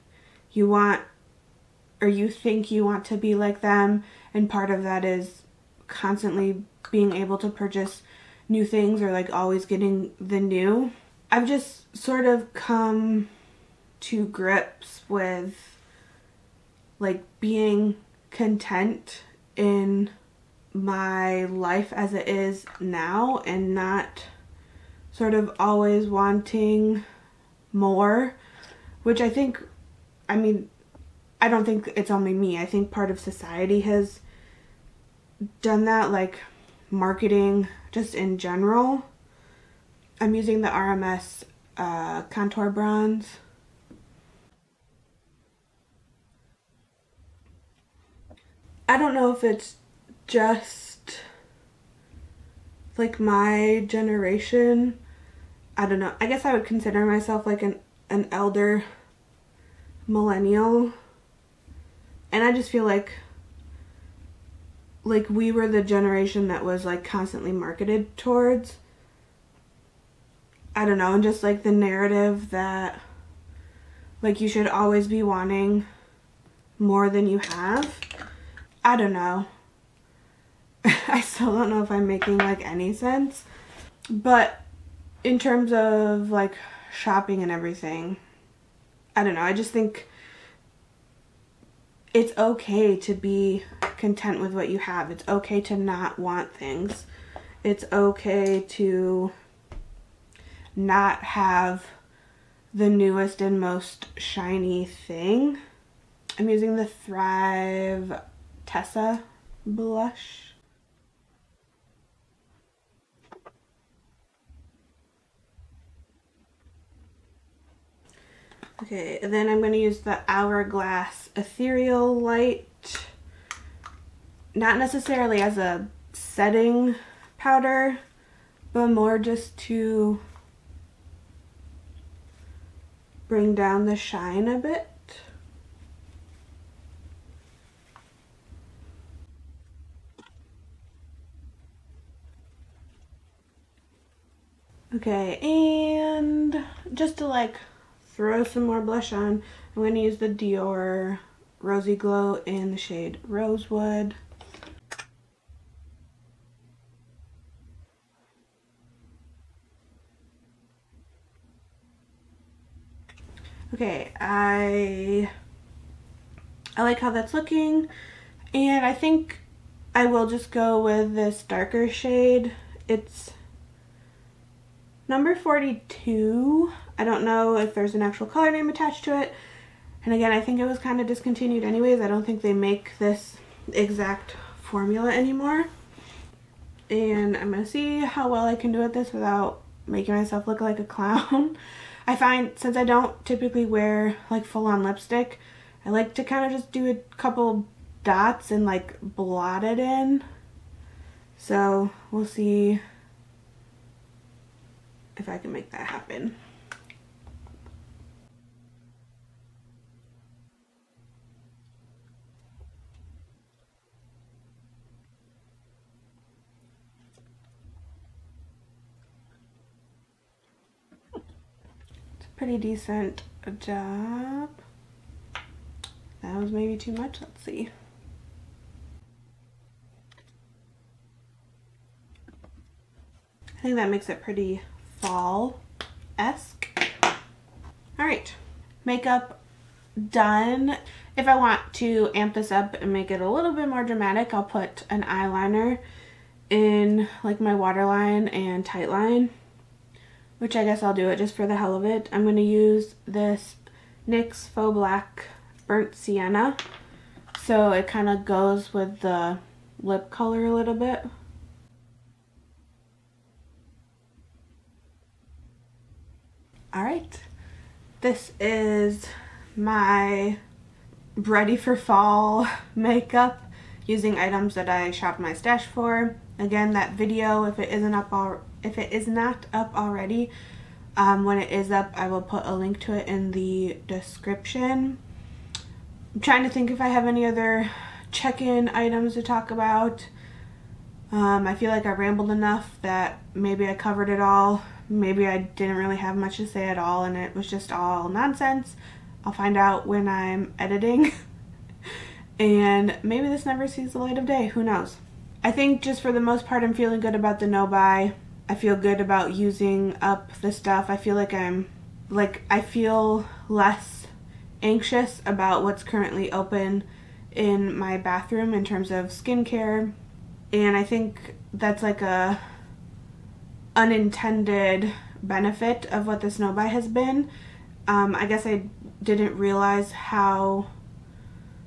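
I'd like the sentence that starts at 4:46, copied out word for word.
I'm trying to think if I have any other check-in items to talk about.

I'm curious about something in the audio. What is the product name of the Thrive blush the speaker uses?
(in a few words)
Tessa.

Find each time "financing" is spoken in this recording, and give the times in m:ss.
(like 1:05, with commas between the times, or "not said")
not said.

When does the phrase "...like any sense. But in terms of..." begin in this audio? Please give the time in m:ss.
1:22.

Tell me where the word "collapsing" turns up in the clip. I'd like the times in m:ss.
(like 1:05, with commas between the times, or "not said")
not said.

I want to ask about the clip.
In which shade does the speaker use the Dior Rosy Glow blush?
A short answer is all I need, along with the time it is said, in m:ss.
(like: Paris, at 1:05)
Rosewood, at 2:33.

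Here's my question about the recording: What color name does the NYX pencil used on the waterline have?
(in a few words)
Burnt Sienna.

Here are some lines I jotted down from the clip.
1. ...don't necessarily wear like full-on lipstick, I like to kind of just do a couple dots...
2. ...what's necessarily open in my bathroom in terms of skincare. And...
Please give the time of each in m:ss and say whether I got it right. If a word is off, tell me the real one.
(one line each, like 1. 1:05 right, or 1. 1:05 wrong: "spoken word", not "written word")
1. 3:12 wrong: "typically", not "necessarily"
2. 5:15 wrong: "currently", not "necessarily".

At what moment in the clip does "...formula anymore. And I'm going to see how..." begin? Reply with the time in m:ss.
3:04.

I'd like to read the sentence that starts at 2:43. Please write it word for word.
Okay, I I like how that's looking.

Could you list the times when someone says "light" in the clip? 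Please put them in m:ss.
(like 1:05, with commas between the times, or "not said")
2:02, 5:03.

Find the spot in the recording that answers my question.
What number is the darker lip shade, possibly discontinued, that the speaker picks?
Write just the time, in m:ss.
2:55.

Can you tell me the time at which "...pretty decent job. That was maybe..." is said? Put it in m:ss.
3:42.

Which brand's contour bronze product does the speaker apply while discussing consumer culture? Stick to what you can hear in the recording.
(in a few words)
RMS.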